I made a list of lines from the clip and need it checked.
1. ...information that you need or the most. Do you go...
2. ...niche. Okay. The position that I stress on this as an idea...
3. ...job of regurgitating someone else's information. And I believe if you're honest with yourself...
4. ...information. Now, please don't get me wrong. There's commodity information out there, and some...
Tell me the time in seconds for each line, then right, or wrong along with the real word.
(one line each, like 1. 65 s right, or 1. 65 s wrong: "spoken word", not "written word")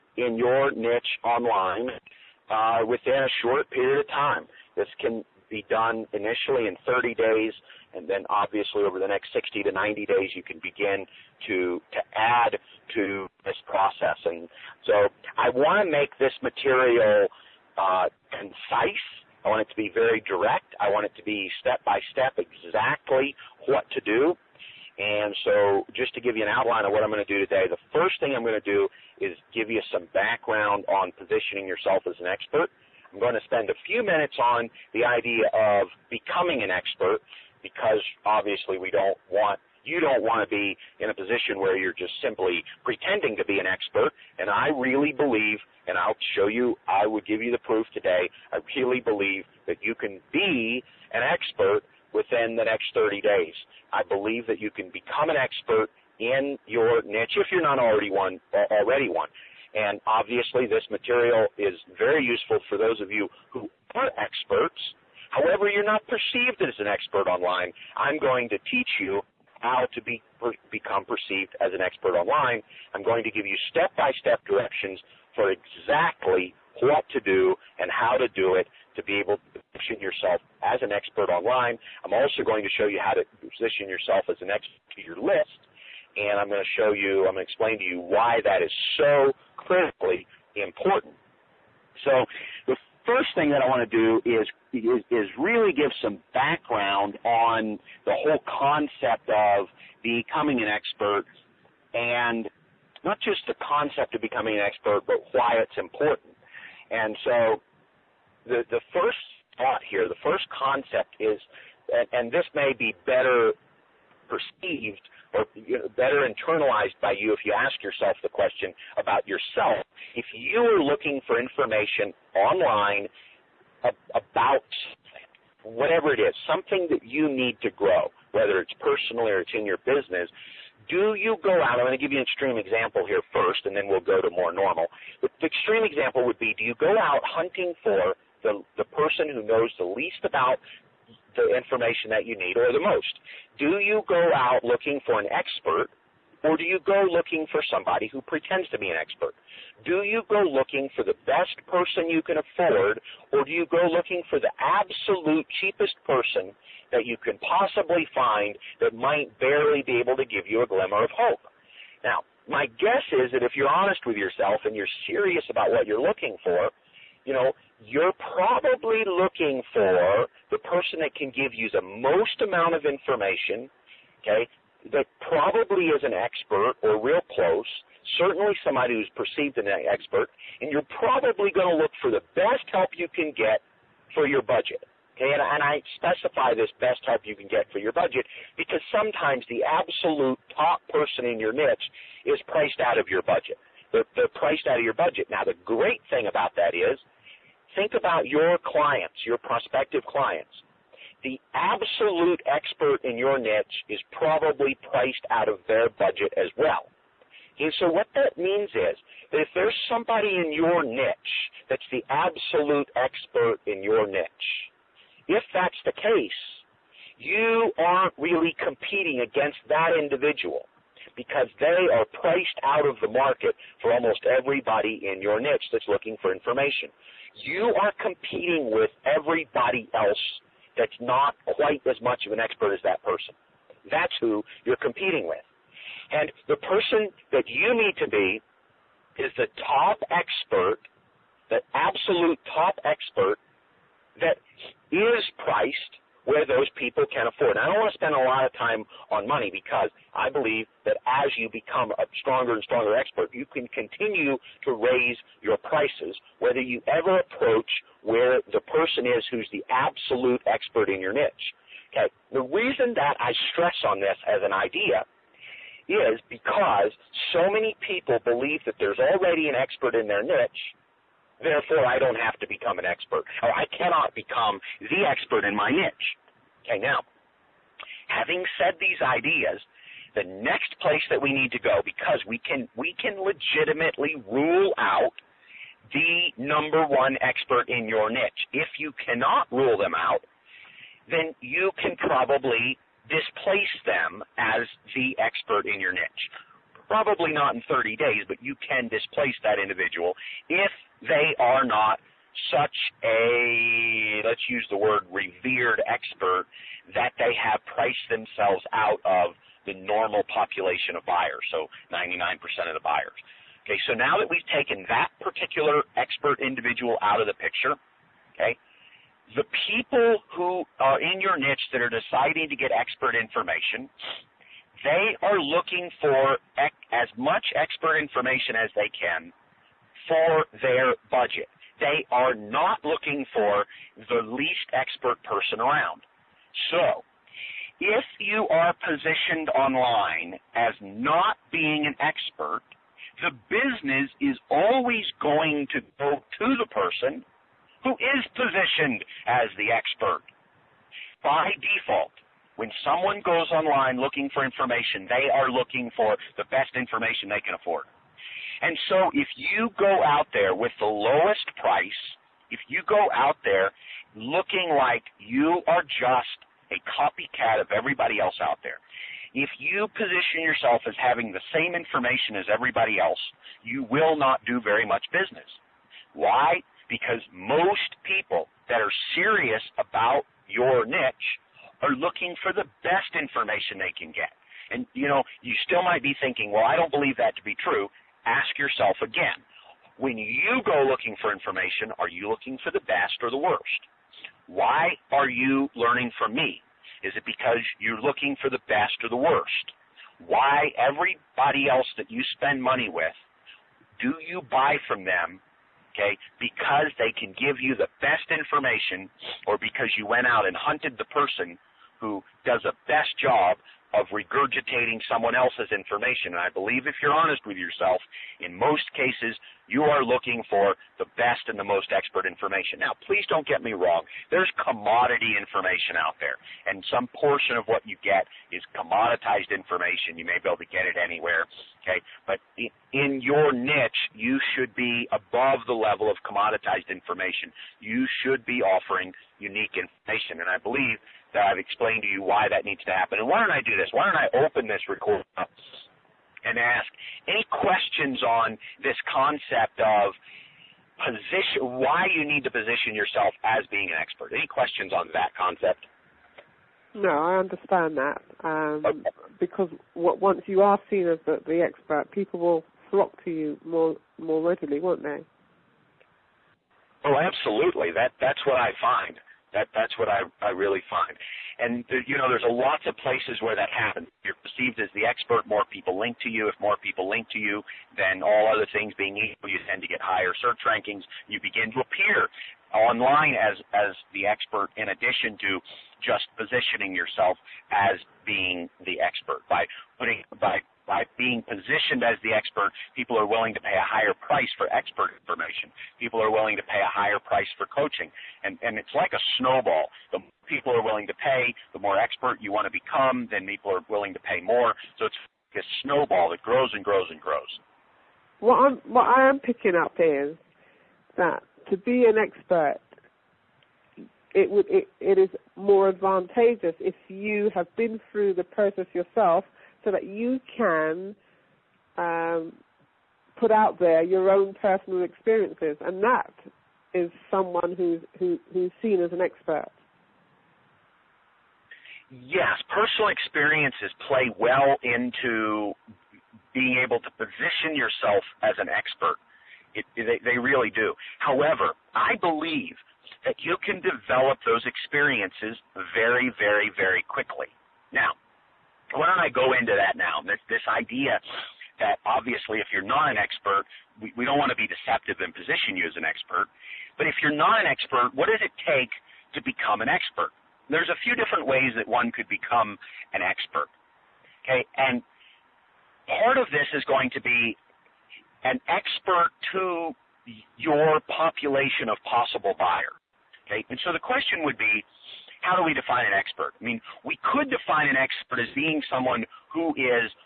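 1. 141 s right
2. 261 s wrong: "reason", not "position"
3. 413 s right
4. 422 s right.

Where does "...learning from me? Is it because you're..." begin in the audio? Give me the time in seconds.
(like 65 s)
395 s.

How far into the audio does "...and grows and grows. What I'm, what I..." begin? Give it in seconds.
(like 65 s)
506 s.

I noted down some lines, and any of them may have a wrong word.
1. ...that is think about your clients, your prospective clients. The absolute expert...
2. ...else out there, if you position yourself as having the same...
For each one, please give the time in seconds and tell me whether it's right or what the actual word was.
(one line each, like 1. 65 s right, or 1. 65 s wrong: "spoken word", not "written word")
1. 196 s right
2. 368 s right.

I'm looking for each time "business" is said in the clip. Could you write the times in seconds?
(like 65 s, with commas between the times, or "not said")
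129 s, 343 s, 375 s.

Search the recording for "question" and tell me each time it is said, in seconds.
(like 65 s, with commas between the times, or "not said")
118 s, 447 s, 454 s, 574 s.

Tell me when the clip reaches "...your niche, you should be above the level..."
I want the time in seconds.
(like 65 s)
433 s.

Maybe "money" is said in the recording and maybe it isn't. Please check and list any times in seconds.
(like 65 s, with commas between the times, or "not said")
249 s, 402 s.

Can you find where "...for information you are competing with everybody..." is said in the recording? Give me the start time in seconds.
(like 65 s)
226 s.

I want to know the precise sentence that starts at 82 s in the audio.
I'm also going to show you how to position yourself as an expert to your list.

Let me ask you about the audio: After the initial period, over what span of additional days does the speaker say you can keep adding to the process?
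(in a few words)
60 to 90 days.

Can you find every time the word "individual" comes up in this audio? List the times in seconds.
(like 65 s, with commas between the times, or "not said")
219 s, 299 s, 316 s.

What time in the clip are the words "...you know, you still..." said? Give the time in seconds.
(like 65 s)
384 s.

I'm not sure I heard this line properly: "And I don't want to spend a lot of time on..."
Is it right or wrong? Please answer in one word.
right.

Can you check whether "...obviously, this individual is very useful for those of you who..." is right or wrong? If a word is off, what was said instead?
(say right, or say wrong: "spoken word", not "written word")
wrong: "material", not "individual".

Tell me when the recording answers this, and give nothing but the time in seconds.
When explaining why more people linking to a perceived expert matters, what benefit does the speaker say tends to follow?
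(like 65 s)
480 s.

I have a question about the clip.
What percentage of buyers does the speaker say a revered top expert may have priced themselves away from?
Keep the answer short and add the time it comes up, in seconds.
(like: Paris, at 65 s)
99%, at 311 s.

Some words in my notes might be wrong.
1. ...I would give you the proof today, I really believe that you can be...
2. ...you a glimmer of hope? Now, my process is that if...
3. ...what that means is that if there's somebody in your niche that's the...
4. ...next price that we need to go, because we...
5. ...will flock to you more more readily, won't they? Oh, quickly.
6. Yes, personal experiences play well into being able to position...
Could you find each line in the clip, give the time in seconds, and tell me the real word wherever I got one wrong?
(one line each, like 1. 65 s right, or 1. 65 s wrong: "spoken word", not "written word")
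1. 46 s right
2. 160 s wrong: "guess", not "process"
3. 207 s right
4. 280 s wrong: "place", not "price"
5. 462 s wrong: "absolutely", not "quickly"
6. 532 s right.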